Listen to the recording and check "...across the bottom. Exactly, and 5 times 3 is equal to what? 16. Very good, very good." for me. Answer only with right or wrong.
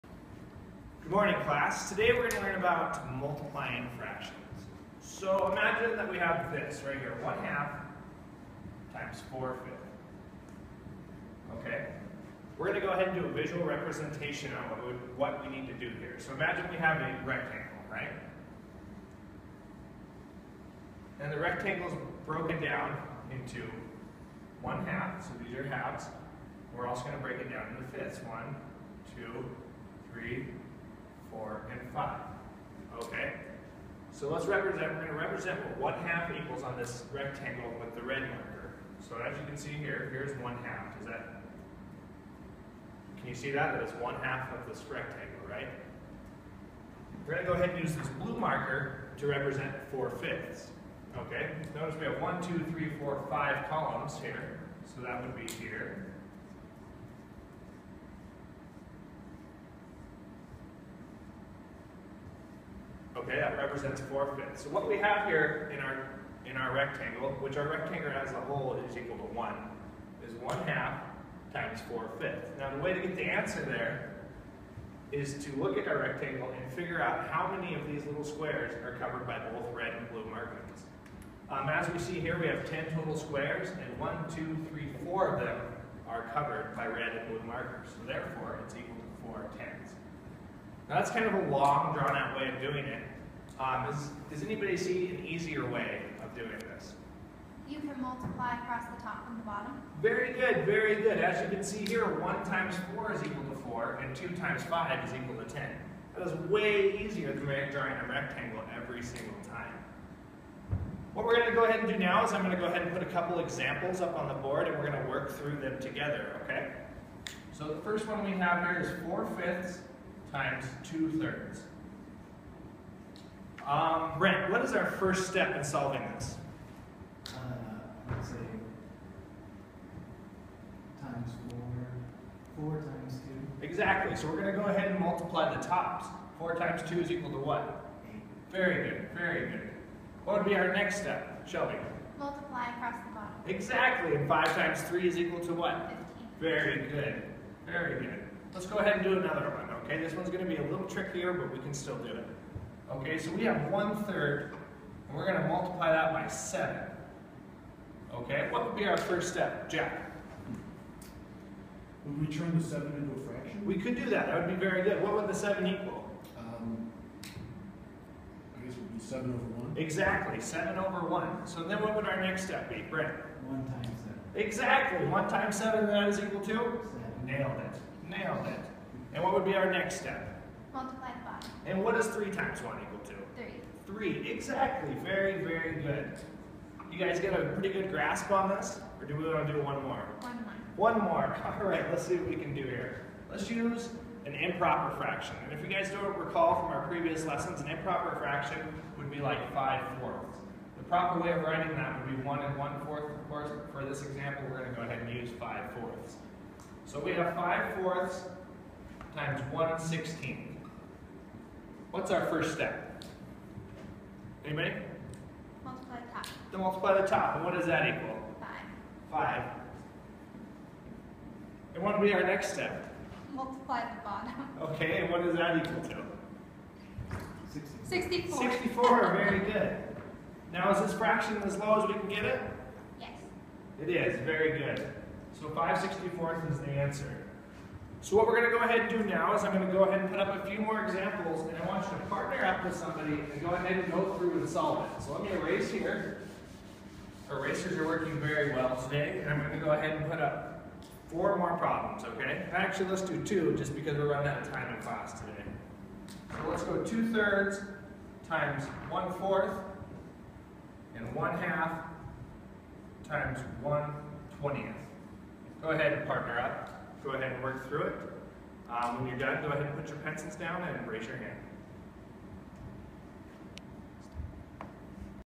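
wrong.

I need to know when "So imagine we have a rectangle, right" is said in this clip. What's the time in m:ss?
0:16.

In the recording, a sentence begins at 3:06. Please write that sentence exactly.
You guys get a pretty good grasp on this?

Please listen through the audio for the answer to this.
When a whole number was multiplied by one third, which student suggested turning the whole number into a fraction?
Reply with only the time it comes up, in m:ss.
2:39.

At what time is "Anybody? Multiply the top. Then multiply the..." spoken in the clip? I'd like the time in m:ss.
3:34.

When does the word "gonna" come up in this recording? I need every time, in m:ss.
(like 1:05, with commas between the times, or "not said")
2:30, 2:35.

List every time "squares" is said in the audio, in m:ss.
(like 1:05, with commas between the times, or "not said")
1:18, 1:23.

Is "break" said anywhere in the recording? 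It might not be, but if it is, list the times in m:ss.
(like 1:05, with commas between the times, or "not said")
0:27.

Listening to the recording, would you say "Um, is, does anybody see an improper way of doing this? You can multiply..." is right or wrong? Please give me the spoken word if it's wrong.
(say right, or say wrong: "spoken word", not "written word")
wrong: "easier", not "improper".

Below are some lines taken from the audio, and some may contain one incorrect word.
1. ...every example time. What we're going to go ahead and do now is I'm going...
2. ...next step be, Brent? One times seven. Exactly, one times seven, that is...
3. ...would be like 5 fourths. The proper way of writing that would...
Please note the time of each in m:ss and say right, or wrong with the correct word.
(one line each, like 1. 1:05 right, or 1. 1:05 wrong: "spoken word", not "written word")
1. 1:48 wrong: "single", not "example"
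2. 2:52 right
3. 3:18 right.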